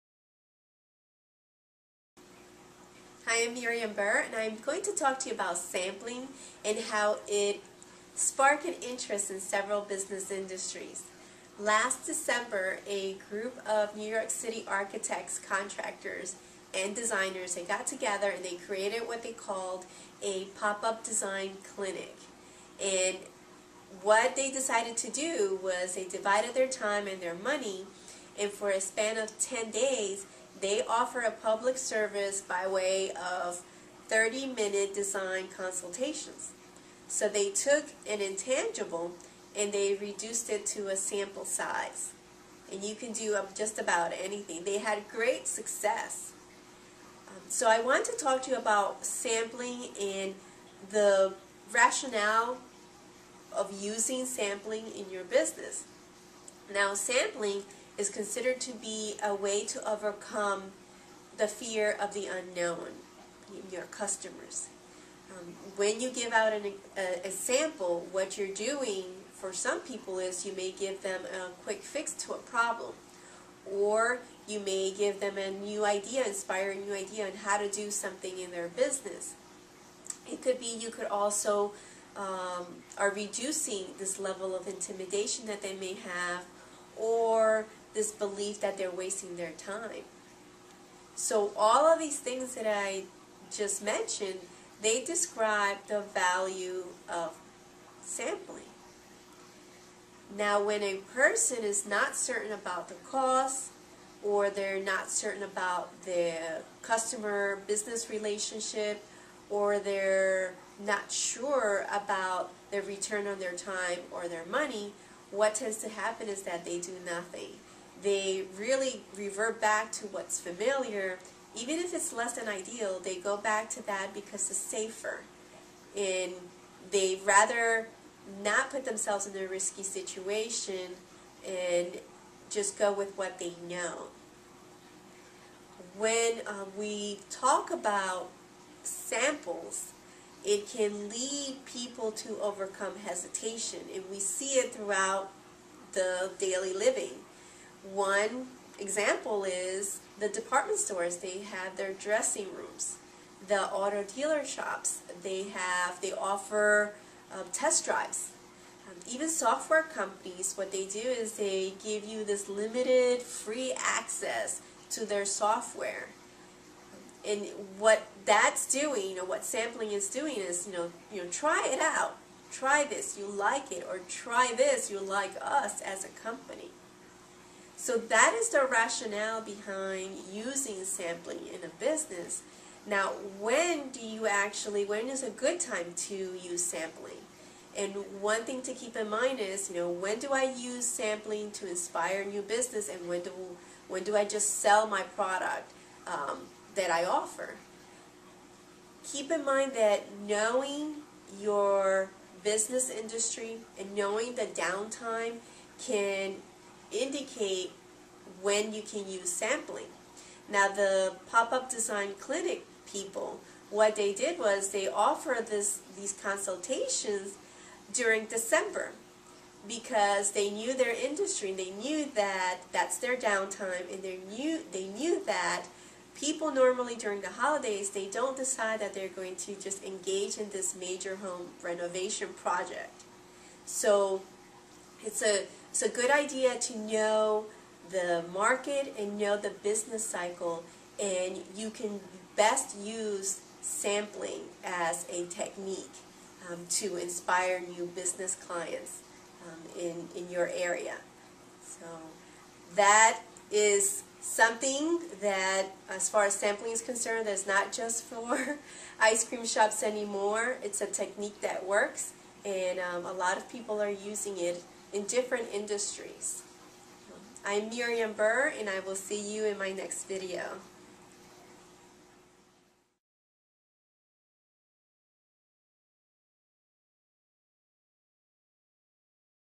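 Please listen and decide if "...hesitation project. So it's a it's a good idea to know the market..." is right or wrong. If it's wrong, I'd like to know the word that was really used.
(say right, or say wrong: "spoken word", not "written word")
wrong: "renovation", not "hesitation".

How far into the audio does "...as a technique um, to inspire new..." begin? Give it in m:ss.
4:04.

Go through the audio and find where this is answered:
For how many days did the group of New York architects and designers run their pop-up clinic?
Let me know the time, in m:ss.
0:29.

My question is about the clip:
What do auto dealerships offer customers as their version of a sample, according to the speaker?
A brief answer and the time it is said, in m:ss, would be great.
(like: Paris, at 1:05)
Test drives, at 2:37.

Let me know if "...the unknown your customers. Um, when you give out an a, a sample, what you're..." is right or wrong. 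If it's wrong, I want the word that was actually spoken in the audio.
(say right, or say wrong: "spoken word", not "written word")
right.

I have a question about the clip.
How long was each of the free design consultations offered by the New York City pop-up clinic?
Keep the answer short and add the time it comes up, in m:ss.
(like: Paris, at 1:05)
30 minutes, at 0:34.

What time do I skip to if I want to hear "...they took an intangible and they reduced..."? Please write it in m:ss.
0:37.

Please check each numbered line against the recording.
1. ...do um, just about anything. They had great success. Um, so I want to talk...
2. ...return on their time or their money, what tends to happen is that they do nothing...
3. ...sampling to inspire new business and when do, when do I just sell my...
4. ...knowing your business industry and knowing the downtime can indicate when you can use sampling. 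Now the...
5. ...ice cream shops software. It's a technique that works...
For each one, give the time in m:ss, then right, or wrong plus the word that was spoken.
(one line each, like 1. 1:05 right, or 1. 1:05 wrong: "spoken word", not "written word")
1. 0:43 right
2. 1:52 right
3. 3:10 right
4. 3:20 right
5. 4:18 wrong: "anymore", not "software".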